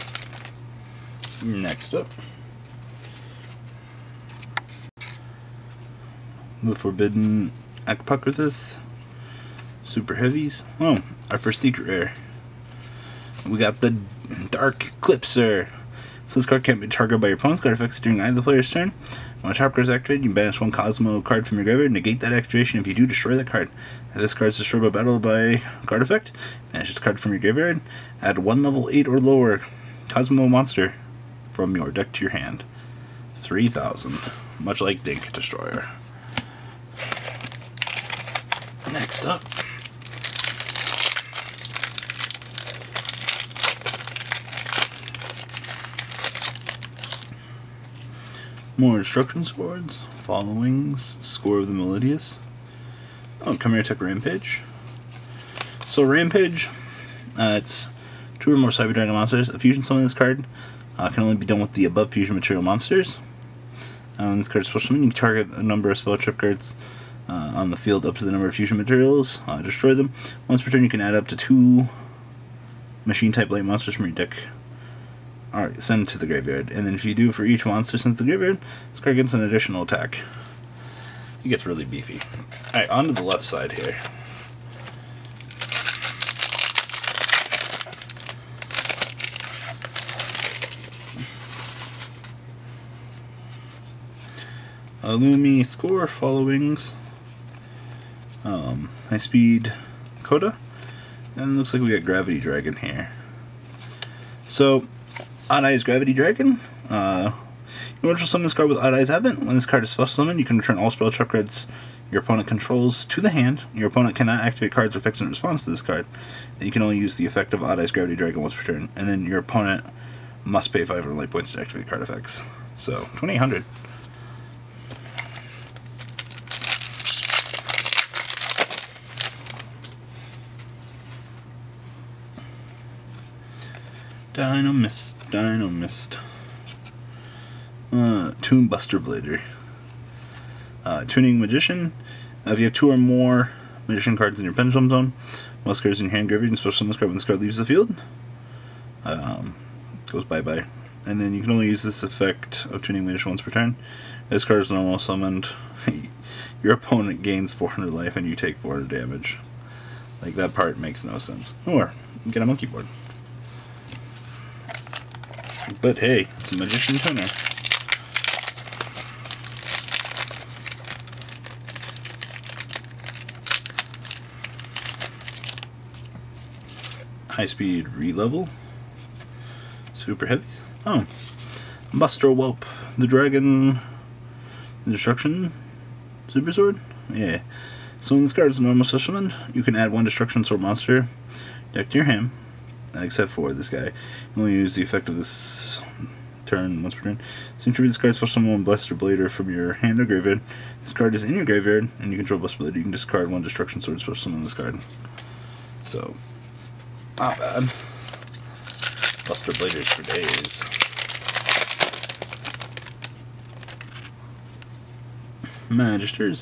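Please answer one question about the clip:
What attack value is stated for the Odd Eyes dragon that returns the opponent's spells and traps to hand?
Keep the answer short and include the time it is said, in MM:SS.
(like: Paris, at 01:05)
2800, at 02:03.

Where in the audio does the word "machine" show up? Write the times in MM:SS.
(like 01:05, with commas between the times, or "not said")
01:13.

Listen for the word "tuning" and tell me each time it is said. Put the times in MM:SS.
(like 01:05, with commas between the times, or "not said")
02:21, 02:32.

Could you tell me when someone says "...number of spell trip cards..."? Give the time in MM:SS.
01:05.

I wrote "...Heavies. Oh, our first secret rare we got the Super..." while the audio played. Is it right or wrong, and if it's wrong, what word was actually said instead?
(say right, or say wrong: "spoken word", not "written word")
wrong: "Dark", not "Super".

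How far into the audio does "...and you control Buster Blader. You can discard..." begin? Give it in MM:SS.
03:21.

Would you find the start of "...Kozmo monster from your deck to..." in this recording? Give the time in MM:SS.
00:30.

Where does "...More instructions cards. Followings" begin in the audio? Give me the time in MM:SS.
00:48.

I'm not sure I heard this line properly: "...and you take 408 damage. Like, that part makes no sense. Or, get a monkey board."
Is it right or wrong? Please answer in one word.
wrong.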